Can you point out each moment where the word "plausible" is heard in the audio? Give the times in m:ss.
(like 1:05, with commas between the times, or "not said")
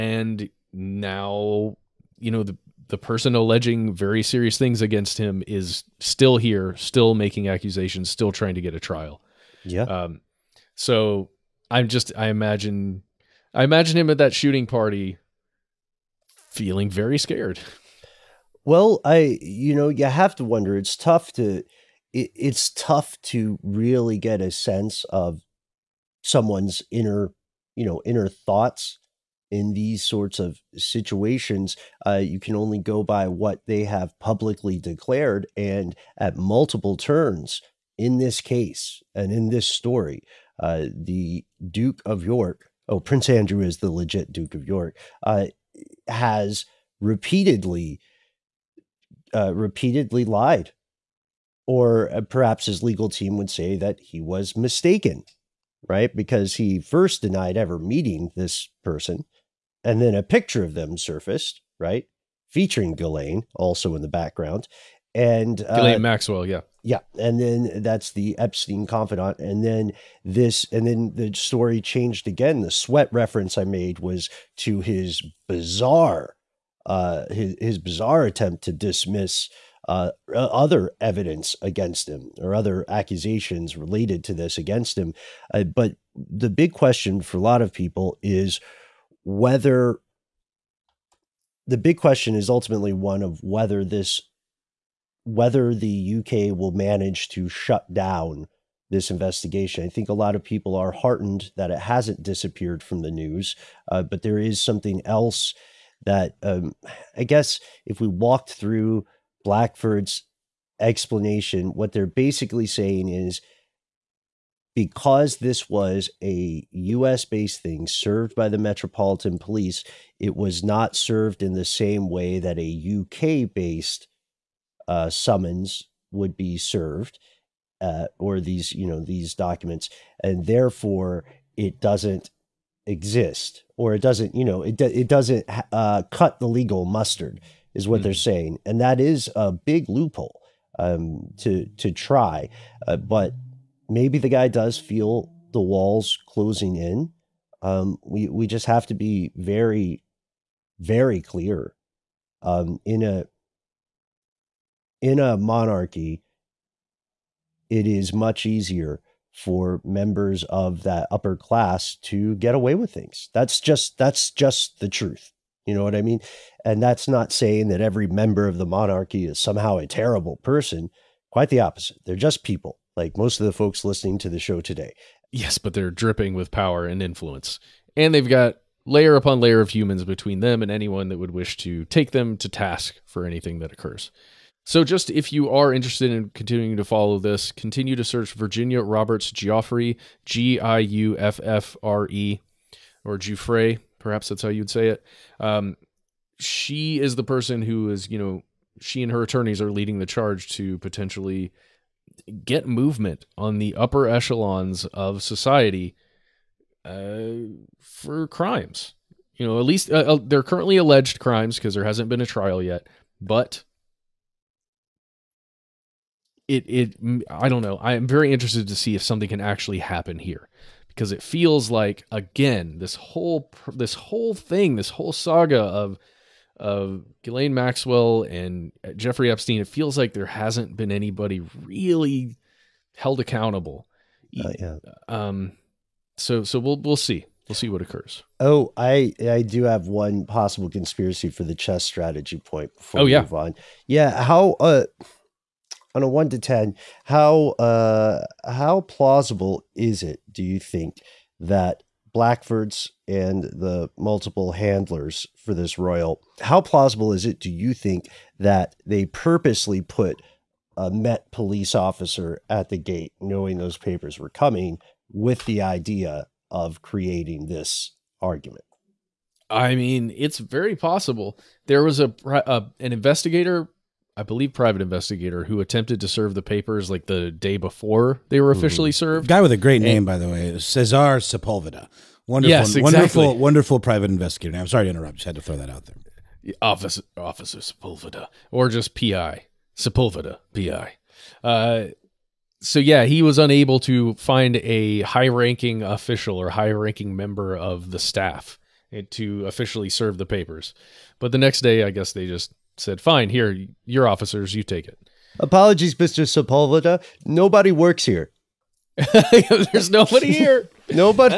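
4:08, 4:16.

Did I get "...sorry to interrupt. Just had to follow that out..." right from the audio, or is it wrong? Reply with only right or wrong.
wrong.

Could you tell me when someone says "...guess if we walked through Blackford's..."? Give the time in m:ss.
1:47.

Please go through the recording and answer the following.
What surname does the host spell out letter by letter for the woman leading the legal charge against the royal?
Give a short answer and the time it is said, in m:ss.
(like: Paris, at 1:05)
Giuffre, at 3:10.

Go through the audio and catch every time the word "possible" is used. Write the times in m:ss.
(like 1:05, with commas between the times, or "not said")
4:00, 4:30.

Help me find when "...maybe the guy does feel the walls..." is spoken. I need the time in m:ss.
2:23.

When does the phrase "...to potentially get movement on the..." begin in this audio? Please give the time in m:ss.
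3:20.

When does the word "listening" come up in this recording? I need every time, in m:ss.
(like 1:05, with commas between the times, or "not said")
2:53.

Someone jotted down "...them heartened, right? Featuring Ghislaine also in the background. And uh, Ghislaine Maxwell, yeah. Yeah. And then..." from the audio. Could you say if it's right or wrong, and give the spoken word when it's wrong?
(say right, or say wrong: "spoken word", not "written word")
wrong: "surfaced", not "heartened".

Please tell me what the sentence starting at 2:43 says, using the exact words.
That's just that's just the truth.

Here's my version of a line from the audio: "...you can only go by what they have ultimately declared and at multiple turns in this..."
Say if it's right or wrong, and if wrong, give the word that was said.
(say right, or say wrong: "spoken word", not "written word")
wrong: "publicly", not "ultimately".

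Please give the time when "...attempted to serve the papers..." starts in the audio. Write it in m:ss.
4:35.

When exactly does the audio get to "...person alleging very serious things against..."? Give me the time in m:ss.
0:02.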